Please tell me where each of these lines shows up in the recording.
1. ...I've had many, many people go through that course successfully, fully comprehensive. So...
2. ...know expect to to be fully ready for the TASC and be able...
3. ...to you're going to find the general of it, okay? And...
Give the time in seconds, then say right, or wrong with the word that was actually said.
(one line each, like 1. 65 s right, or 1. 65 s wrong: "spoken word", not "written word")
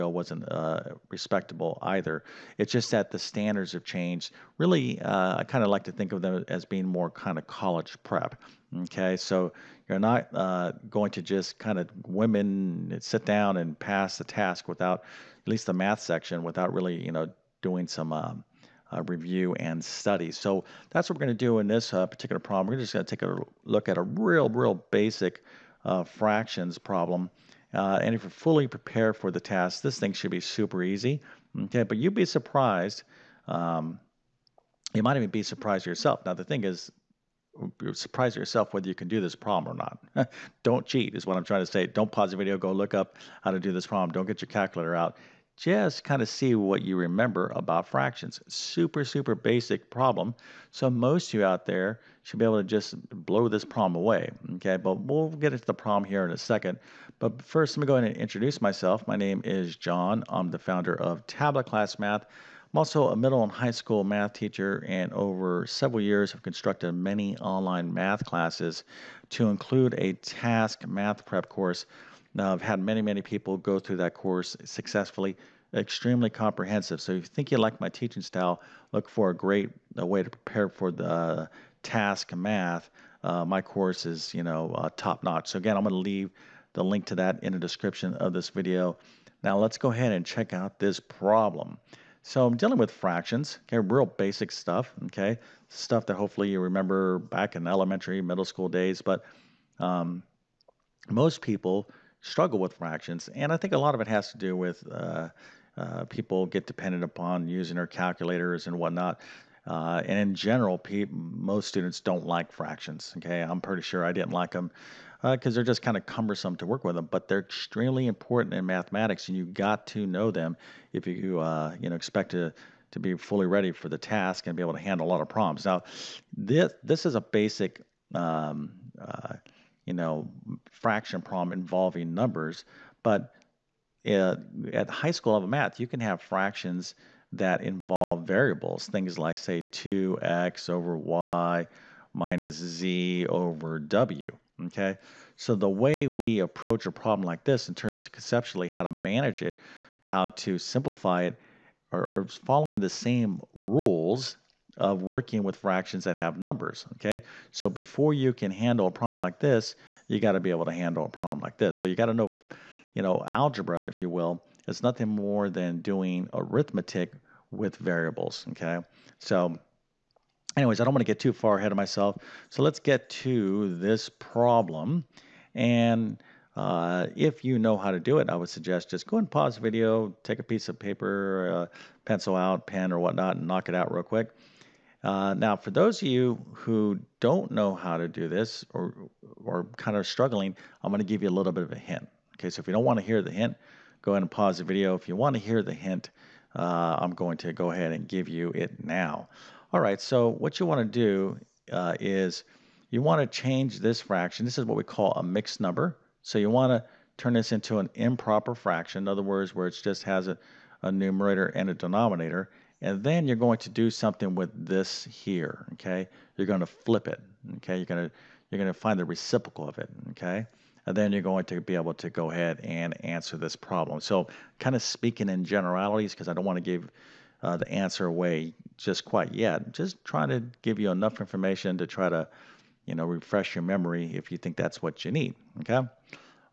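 1. 72 s wrong: "extremely", not "fully"
2. 121 s right
3. 218 s wrong: "reciprocal", not "general".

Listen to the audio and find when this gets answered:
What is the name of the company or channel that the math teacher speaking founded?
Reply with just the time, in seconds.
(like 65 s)
61 s.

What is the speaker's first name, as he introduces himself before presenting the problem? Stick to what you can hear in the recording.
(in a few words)
John.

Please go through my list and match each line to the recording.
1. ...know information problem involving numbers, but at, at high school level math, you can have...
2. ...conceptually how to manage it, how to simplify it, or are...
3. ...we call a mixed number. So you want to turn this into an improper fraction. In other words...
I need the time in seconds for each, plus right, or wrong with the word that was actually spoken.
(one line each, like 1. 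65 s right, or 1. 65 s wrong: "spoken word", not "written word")
1. 129 s wrong: "fraction", not "information"
2. 148 s right
3. 204 s right.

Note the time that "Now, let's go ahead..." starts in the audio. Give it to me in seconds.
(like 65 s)
89 s.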